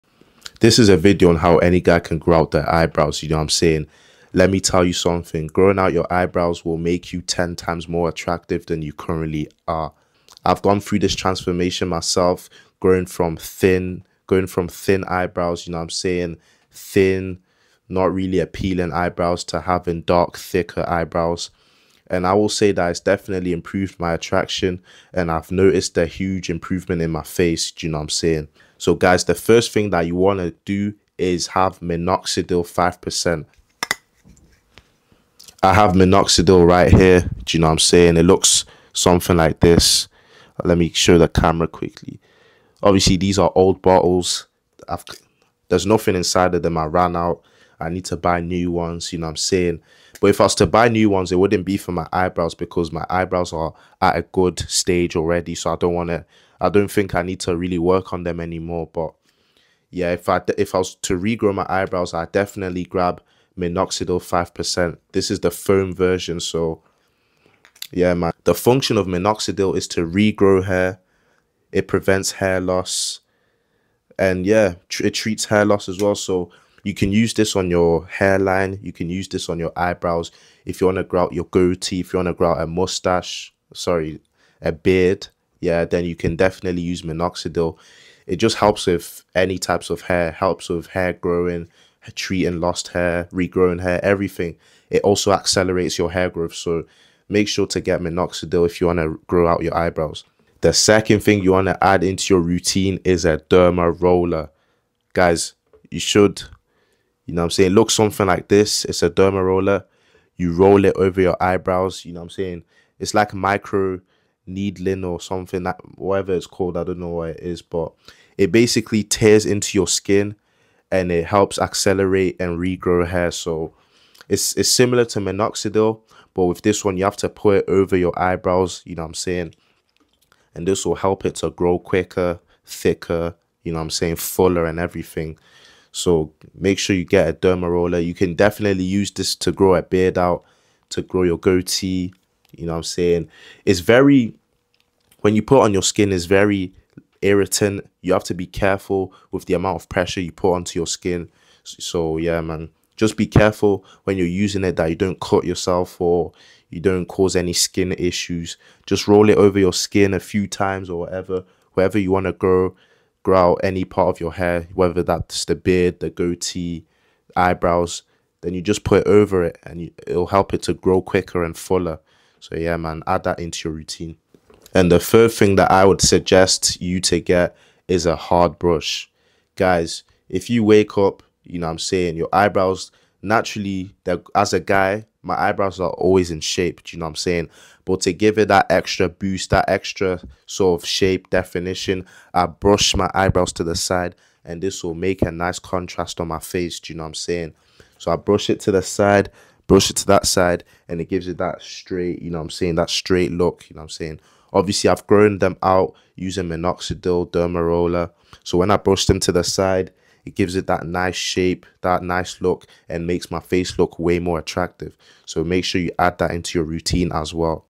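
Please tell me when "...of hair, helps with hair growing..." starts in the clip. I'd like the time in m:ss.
1:29.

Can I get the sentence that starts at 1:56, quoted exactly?
I don't know what it is, but it basically tears into your skin and it helps accelerate and regrow hair.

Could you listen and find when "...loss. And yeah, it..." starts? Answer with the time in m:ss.
1:12.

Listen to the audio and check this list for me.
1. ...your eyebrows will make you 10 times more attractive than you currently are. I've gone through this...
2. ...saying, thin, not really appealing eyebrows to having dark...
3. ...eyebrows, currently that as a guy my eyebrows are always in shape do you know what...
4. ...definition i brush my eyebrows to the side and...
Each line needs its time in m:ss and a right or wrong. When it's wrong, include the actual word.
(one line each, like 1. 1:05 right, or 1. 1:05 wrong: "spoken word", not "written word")
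1. 0:05 right
2. 0:15 right
3. 3:02 wrong: "naturally", not "currently"
4. 3:11 right.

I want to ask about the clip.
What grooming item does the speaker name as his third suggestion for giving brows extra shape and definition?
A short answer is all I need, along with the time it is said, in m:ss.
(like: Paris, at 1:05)
hard brush, at 2:58.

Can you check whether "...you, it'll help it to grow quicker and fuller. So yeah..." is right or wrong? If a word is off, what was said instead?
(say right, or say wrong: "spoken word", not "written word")
right.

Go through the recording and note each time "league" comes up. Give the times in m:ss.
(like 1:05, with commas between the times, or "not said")
not said.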